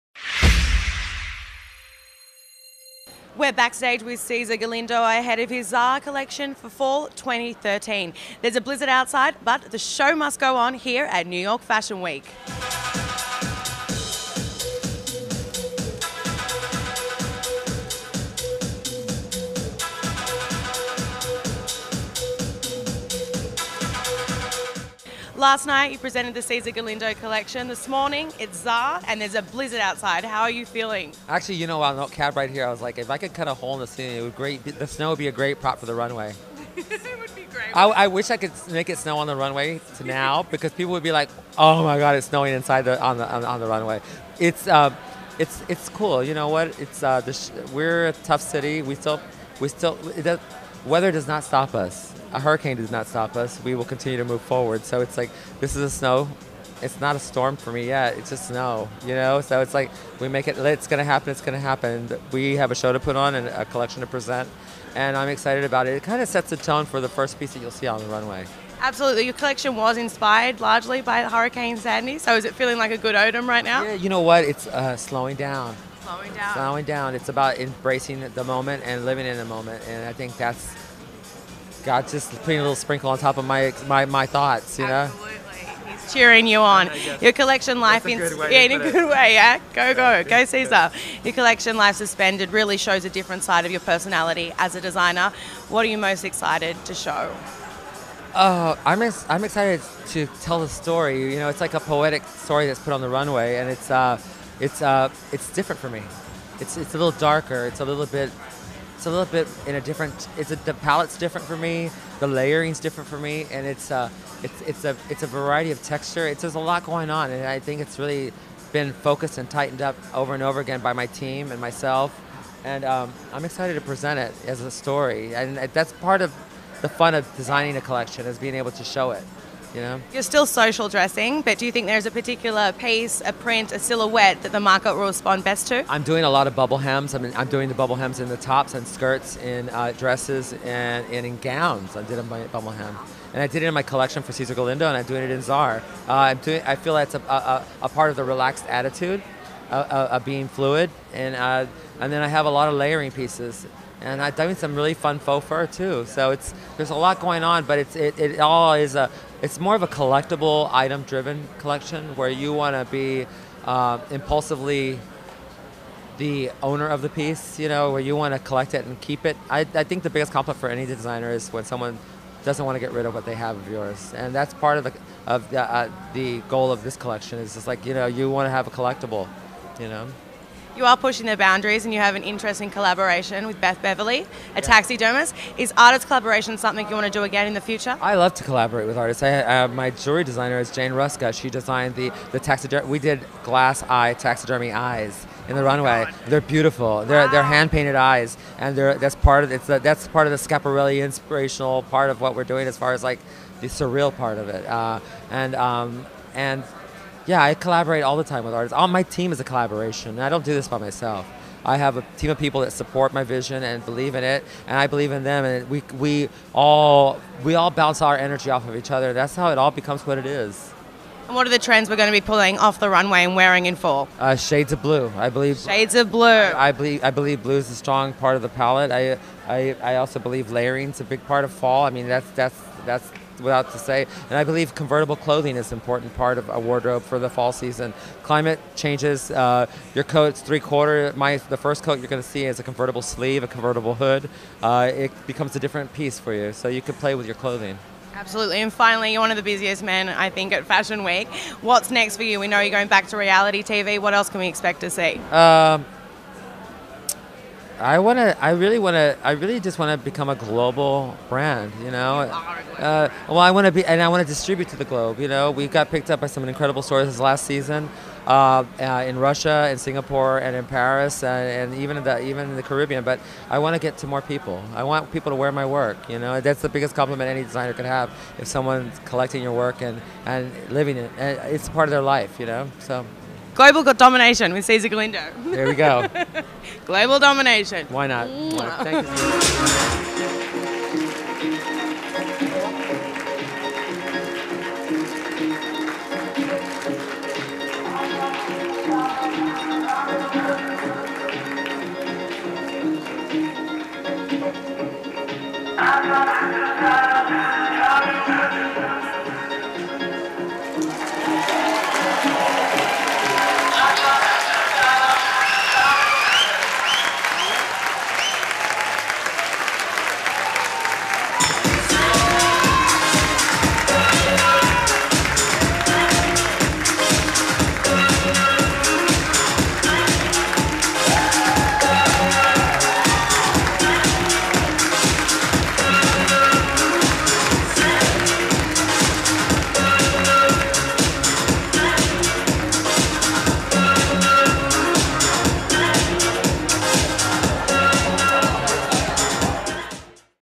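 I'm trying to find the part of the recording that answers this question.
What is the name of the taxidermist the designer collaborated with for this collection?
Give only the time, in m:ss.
3:03.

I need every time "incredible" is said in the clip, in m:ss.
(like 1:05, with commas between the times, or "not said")
4:26.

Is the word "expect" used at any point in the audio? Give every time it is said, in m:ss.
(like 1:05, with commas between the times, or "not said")
4:14.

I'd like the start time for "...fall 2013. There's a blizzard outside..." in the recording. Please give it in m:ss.
0:06.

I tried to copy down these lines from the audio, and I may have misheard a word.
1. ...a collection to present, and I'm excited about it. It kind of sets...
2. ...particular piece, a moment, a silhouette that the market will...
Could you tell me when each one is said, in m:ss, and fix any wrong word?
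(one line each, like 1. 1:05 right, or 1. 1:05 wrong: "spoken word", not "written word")
1. 1:03 right
2. 2:12 wrong: "print", not "moment".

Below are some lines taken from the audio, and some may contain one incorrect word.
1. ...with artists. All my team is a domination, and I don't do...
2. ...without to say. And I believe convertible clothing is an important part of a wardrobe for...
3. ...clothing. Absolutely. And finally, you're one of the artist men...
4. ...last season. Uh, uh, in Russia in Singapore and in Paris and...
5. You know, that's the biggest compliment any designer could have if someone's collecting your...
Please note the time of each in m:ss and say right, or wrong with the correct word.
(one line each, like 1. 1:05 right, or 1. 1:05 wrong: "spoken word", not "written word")
1. 3:28 wrong: "collaboration", not "domination"
2. 3:53 right
3. 4:07 wrong: "busiest", not "artist"
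4. 4:27 right
5. 4:36 right.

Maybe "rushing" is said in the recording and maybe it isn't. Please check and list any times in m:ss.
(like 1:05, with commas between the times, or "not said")
not said.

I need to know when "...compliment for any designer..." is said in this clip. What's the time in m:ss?
2:50.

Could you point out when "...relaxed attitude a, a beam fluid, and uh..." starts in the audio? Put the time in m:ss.
2:28.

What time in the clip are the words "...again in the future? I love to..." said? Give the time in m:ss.
3:07.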